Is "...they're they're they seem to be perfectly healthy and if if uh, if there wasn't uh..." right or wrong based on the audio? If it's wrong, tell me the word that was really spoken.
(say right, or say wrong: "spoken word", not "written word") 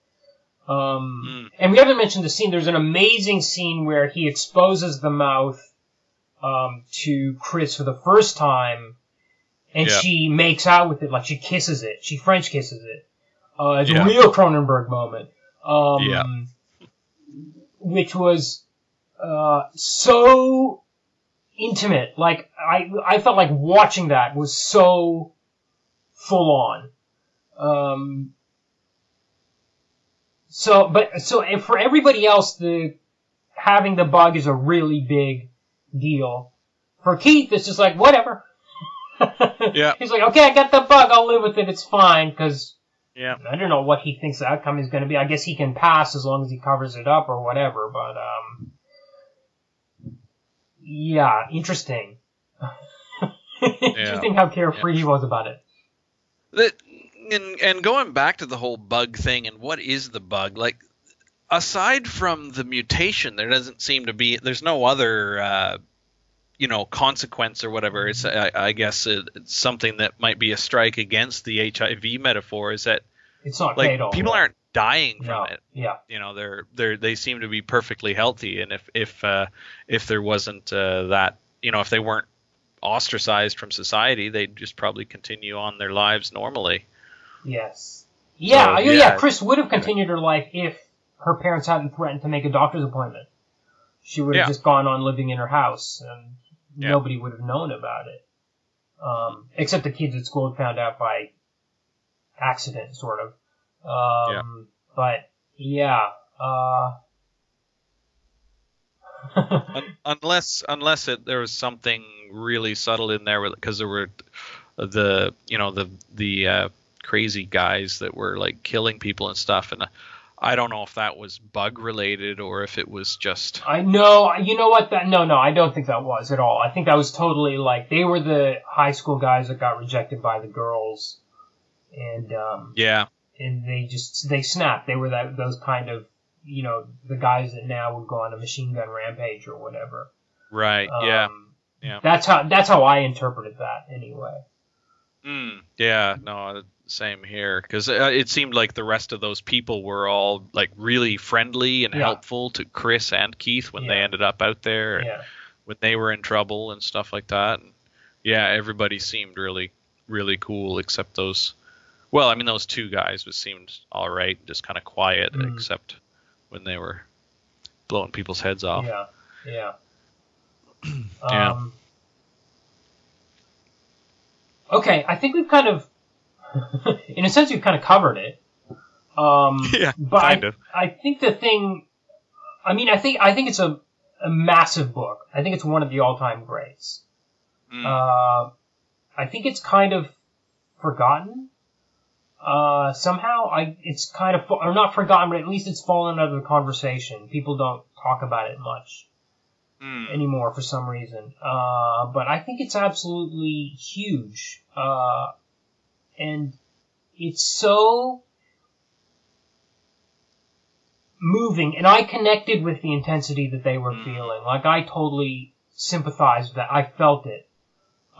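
right.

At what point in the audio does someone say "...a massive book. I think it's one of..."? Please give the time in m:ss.
3:04.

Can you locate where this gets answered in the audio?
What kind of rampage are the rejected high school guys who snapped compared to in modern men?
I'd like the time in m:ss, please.
2:18.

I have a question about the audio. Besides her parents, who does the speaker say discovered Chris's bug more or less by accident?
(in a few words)
The kids at school.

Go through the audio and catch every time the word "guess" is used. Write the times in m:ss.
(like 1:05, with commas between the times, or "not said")
0:45, 1:08.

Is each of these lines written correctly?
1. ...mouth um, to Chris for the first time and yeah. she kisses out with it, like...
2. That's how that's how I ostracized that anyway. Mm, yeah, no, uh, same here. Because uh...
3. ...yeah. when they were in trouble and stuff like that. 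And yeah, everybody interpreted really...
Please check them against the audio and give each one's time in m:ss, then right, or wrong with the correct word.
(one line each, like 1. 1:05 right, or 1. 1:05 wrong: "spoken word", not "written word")
1. 0:05 wrong: "makes", not "kisses"
2. 2:22 wrong: "interpreted", not "ostracized"
3. 2:35 wrong: "seemed", not "interpreted".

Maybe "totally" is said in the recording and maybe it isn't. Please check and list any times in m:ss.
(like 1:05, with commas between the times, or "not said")
2:07, 3:34.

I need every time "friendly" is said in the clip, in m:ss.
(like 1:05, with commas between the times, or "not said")
2:31.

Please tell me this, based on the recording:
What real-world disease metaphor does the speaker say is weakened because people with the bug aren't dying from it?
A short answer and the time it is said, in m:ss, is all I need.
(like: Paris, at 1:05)
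HIV, at 1:11.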